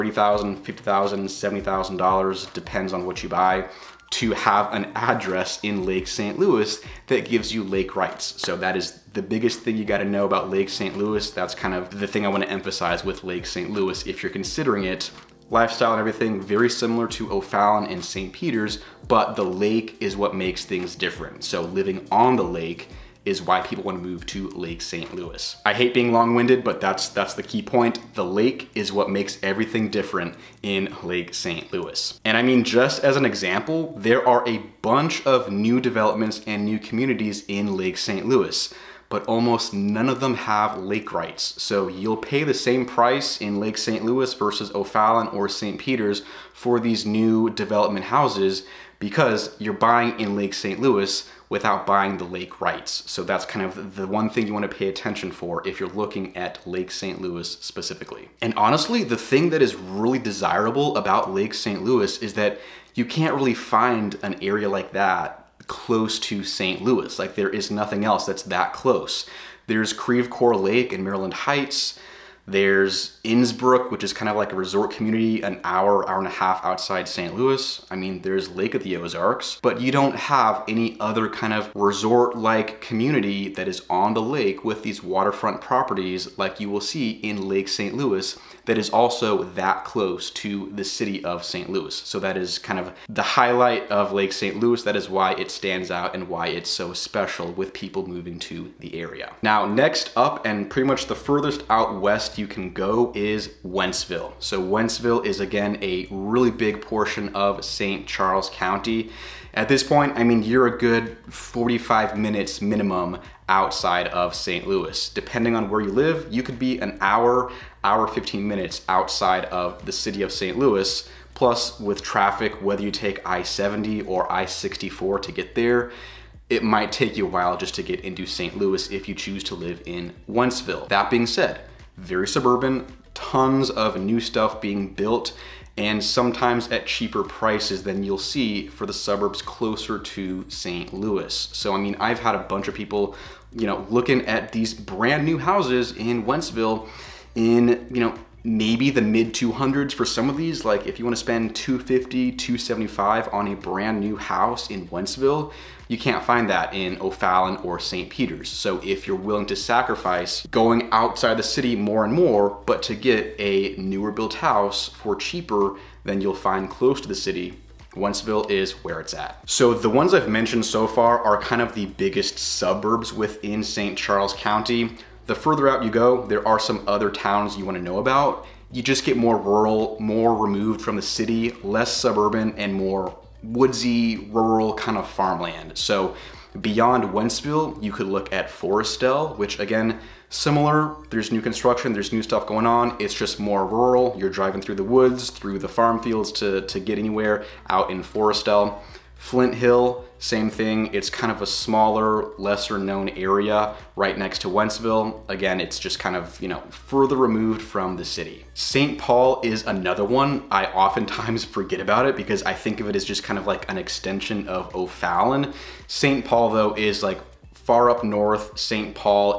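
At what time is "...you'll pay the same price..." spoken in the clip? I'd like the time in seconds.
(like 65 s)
41 s.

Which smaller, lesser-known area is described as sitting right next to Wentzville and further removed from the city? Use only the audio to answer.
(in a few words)
Flint Hill.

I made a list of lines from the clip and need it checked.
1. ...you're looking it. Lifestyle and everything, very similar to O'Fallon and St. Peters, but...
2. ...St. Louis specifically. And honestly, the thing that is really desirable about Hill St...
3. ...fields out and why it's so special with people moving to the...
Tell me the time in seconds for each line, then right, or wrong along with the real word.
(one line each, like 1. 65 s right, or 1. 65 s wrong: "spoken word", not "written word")
1. 14 s wrong: "considering", not "looking"
2. 56 s wrong: "Lake", not "Hill"
3. 95 s wrong: "stands", not "fields".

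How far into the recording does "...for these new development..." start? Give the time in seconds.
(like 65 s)
46 s.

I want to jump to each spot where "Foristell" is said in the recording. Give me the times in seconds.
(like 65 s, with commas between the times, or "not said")
188 s, 198 s.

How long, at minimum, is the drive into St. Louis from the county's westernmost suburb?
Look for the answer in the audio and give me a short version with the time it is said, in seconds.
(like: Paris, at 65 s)
45 minutes, at 111 s.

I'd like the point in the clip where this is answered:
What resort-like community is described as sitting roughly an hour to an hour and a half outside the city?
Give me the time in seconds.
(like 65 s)
73 s.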